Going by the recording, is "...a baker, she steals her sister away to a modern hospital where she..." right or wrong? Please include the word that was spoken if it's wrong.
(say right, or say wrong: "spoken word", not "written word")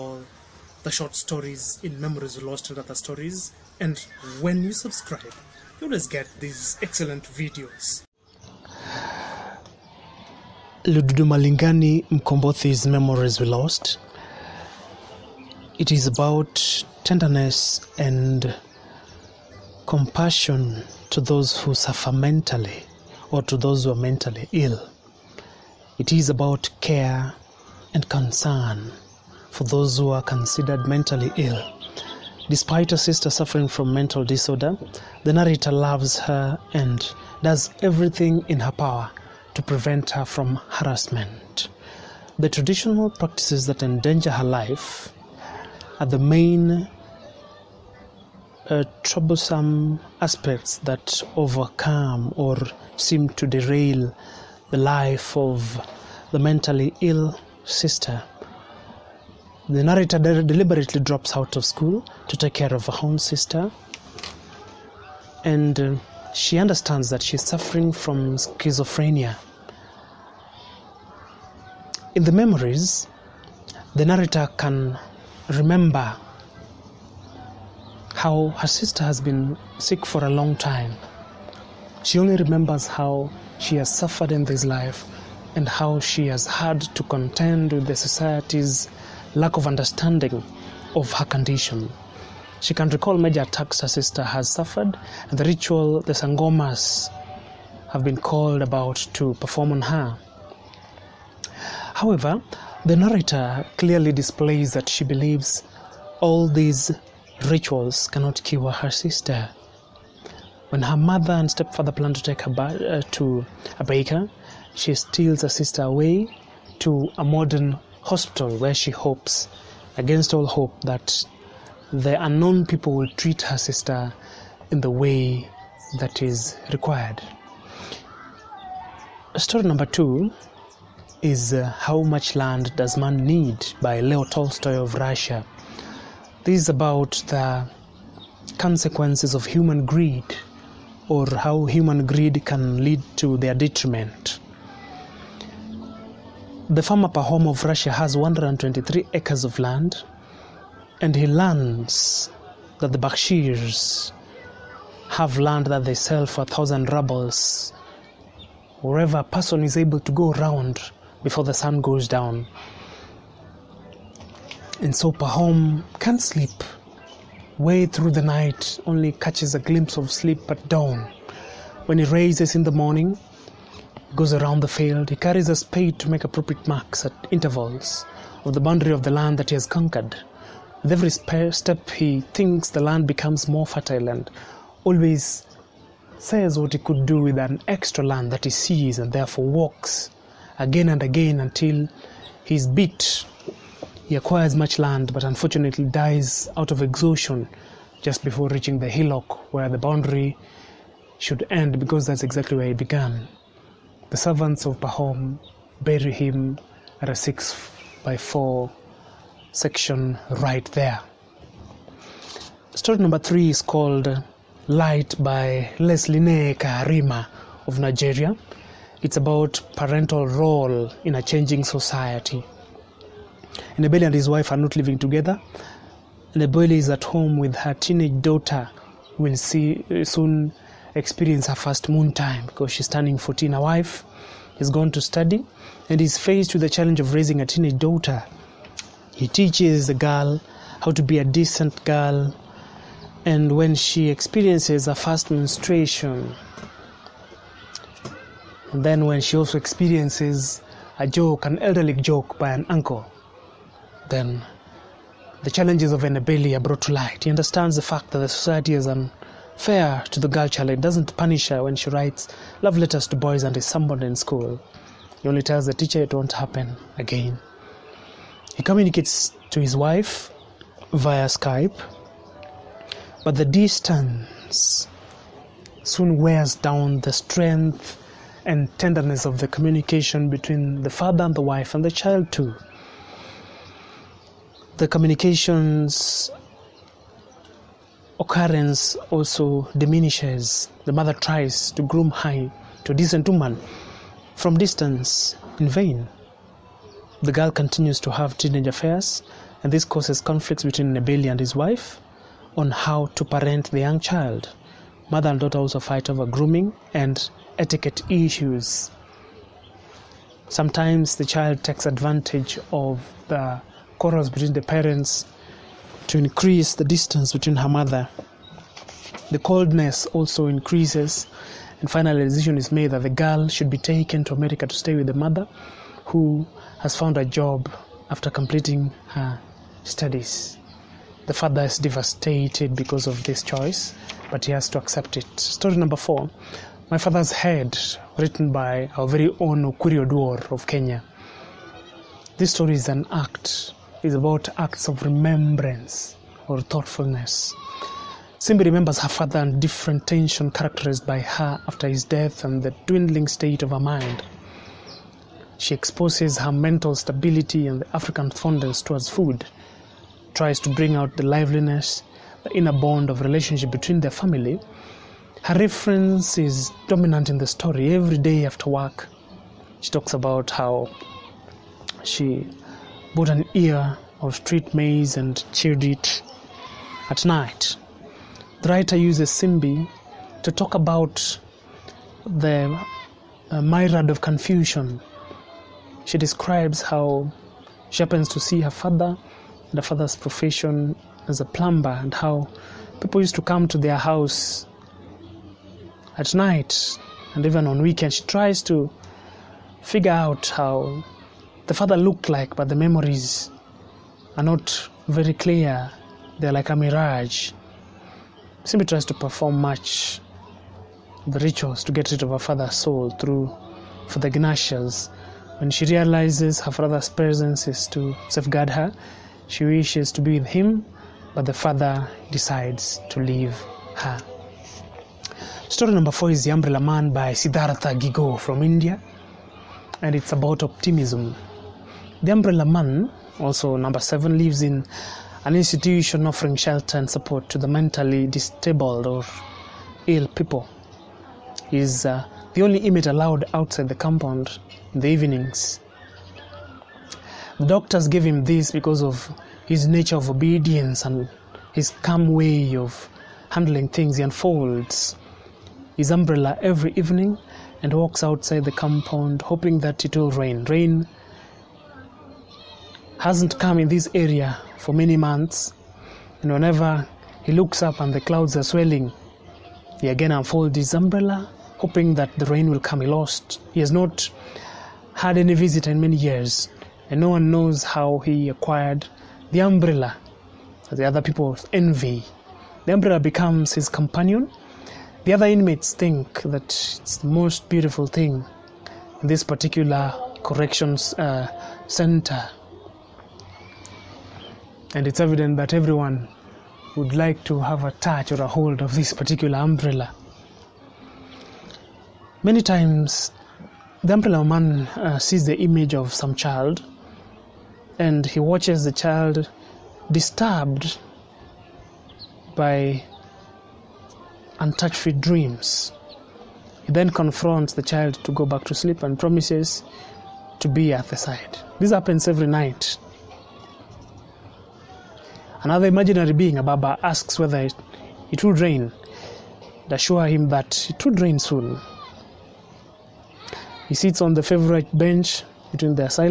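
right.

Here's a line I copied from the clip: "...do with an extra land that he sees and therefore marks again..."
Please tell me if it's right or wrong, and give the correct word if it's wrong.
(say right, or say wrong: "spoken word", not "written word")
wrong: "walks", not "marks".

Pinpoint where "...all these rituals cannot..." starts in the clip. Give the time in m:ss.
1:46.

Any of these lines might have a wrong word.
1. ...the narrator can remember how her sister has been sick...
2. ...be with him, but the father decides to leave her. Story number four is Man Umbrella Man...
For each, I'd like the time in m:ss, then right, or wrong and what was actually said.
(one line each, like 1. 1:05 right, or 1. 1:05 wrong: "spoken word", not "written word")
1. 1:13 right
2. 7:00 wrong: "The", not "Man".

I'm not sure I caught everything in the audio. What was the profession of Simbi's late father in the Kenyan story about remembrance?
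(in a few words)
Plumber.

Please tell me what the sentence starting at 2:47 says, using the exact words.
Way through the night, only catches a glimpse of sleep at dawn.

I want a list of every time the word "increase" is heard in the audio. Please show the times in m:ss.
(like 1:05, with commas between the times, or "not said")
5:16, 5:20.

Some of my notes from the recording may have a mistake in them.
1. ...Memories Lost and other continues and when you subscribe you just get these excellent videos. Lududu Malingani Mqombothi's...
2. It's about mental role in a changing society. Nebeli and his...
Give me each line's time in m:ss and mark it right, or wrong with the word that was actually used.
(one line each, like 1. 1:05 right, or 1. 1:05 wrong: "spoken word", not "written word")
1. 0:01 wrong: "stories", not "continues"
2. 3:39 wrong: "parental", not "mental".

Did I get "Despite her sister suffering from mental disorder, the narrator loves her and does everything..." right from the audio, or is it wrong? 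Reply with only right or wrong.
right.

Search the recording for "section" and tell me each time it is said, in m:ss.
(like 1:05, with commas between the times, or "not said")
3:29.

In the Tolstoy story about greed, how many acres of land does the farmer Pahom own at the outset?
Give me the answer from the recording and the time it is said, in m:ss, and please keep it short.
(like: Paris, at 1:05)
123, at 2:28.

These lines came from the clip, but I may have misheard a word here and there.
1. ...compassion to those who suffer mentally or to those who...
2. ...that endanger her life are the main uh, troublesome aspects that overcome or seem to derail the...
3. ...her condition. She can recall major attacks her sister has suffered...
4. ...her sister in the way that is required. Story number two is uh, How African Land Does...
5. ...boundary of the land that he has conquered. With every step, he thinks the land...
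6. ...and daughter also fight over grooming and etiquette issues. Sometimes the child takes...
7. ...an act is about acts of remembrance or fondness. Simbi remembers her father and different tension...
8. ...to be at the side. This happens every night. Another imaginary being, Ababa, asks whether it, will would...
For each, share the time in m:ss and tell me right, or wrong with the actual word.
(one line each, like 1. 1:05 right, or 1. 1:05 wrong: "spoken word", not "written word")
1. 0:19 right
2. 0:43 right
3. 1:31 right
4. 2:03 wrong: "Much", not "African"
5. 2:58 right
6. 5:05 right
7. 5:42 wrong: "thoughtfulness", not "fondness"
8. 8:40 right.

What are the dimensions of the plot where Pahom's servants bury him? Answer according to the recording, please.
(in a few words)
6 by 4.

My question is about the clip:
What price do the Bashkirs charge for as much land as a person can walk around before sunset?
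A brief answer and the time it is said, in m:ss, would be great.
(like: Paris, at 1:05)
1,000 rubles, at 2:36.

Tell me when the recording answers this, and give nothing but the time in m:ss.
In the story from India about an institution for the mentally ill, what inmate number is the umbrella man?
7:13.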